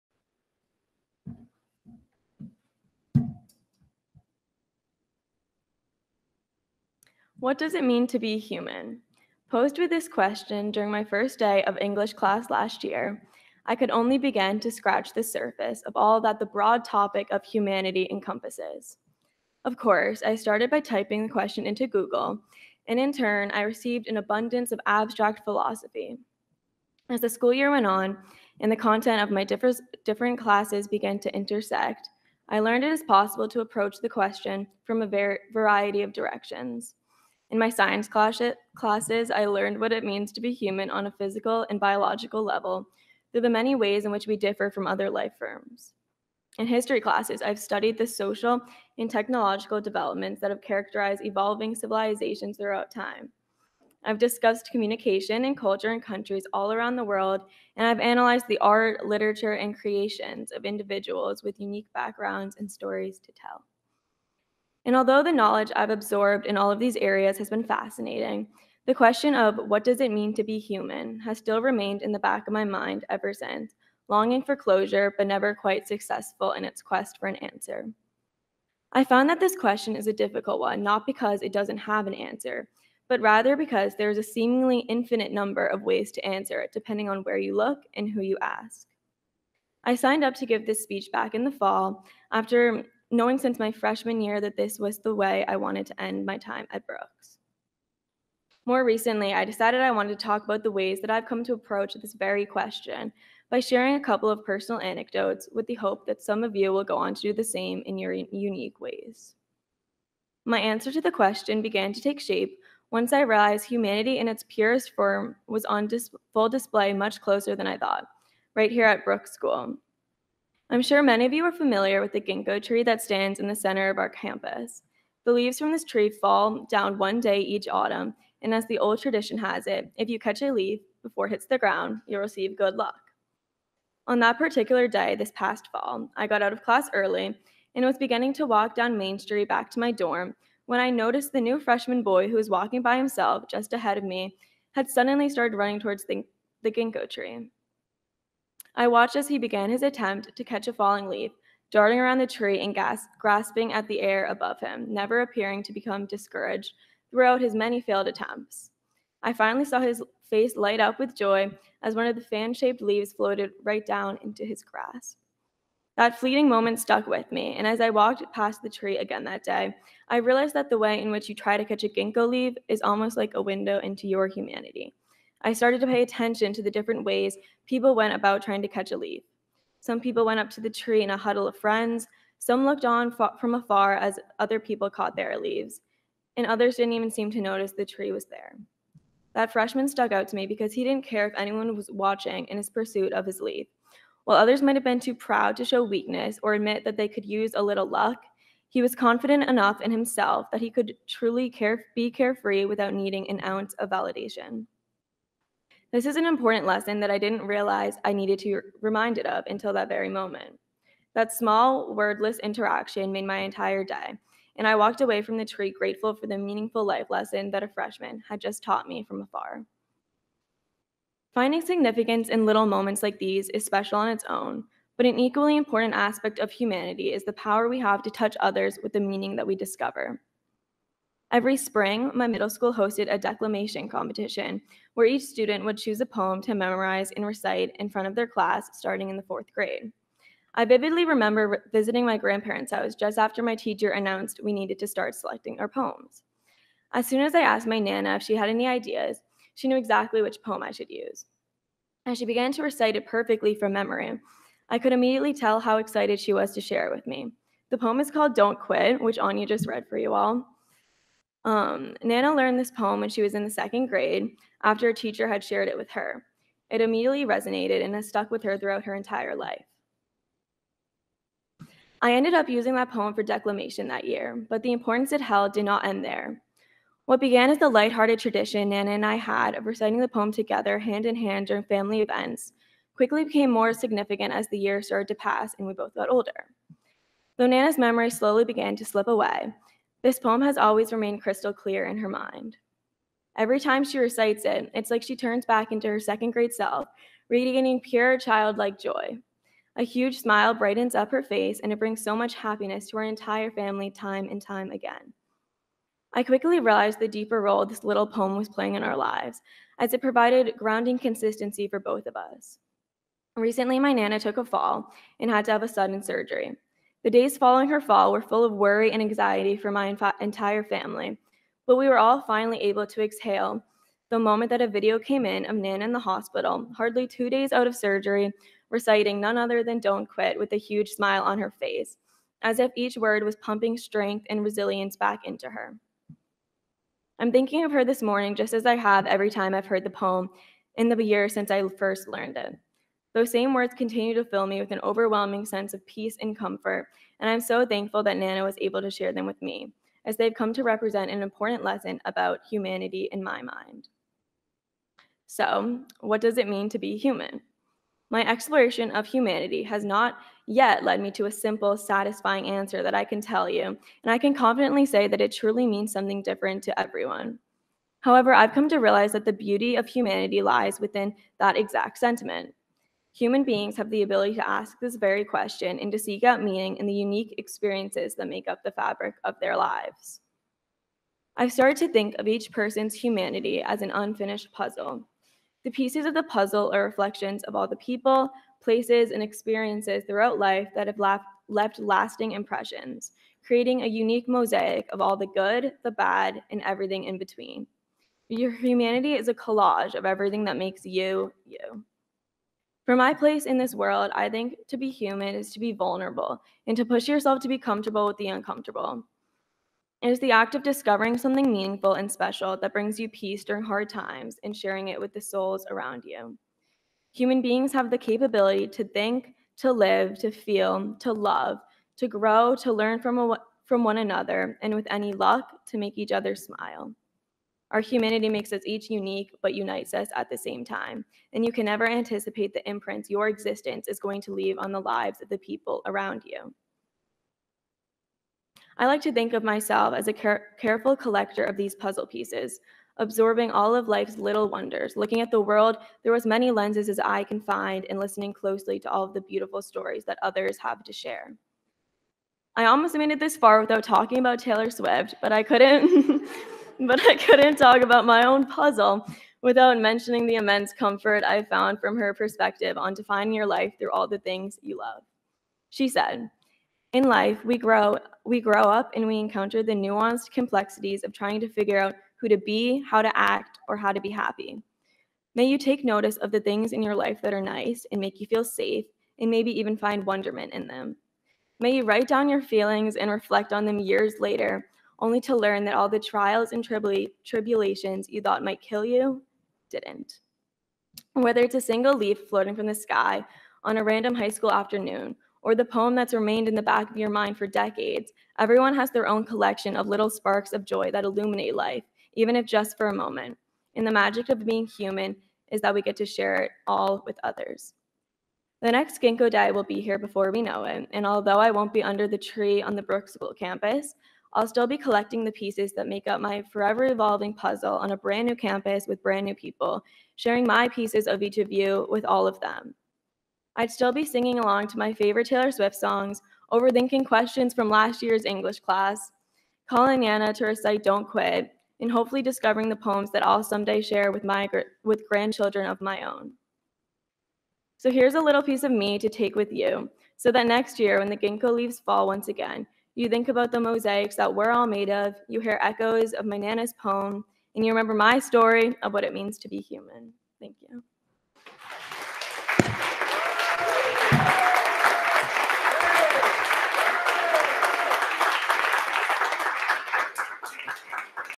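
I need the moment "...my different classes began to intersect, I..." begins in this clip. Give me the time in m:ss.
0:29.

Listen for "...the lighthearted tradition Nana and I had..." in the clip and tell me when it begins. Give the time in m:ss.
4:37.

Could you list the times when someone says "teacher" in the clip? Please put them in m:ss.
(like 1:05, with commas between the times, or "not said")
4:03, 4:24.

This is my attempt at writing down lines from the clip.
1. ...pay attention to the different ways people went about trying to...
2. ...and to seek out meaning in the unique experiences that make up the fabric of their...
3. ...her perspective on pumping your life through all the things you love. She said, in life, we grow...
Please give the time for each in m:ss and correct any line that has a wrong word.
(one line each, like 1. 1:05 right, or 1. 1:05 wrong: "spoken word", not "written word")
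1. 2:55 right
2. 6:15 right
3. 7:41 wrong: "defining", not "pumping".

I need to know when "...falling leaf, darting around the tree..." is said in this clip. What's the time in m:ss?
2:30.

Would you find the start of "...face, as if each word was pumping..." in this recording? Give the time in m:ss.
5:31.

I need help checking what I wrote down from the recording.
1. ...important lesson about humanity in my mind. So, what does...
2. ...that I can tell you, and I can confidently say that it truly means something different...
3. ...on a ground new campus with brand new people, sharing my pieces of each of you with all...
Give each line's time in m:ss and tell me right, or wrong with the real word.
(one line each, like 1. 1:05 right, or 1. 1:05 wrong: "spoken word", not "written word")
1. 5:51 right
2. 6:02 right
3. 8:37 wrong: "brand", not "ground".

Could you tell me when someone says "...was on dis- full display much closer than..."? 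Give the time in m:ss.
1:55.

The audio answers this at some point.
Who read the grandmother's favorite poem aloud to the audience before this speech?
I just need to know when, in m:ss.
4:19.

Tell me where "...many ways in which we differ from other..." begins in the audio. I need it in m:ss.
0:43.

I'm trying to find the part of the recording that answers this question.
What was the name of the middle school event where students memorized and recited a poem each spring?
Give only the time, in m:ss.
3:53.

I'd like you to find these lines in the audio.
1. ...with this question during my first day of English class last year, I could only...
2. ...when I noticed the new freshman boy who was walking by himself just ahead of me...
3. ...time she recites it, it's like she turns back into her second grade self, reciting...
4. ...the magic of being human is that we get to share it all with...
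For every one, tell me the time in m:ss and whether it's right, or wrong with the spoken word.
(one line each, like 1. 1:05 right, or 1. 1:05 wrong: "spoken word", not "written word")
1. 0:09 right
2. 2:20 right
3. 4:53 wrong: "radiating", not "reciting"
4. 8:23 right.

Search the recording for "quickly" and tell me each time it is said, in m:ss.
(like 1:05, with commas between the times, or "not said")
4:42, 5:06.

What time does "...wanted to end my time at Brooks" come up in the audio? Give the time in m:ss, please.
1:35.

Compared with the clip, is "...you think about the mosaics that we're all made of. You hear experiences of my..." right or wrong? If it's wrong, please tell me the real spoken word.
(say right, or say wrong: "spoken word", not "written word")
wrong: "echoes", not "experiences".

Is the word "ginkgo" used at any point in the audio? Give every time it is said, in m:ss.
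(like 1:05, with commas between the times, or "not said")
2:02, 2:26, 2:51, 8:29, 9:01.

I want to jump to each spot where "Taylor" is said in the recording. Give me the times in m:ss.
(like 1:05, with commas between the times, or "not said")
7:34, 8:45.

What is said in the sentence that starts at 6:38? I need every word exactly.
Your humanity is a collage of everything that makes you, you.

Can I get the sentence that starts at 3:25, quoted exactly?
This is an important lesson that I didn't realize I needed to be reminded of until that very moment.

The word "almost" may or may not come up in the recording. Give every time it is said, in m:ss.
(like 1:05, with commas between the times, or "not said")
2:52, 7:32.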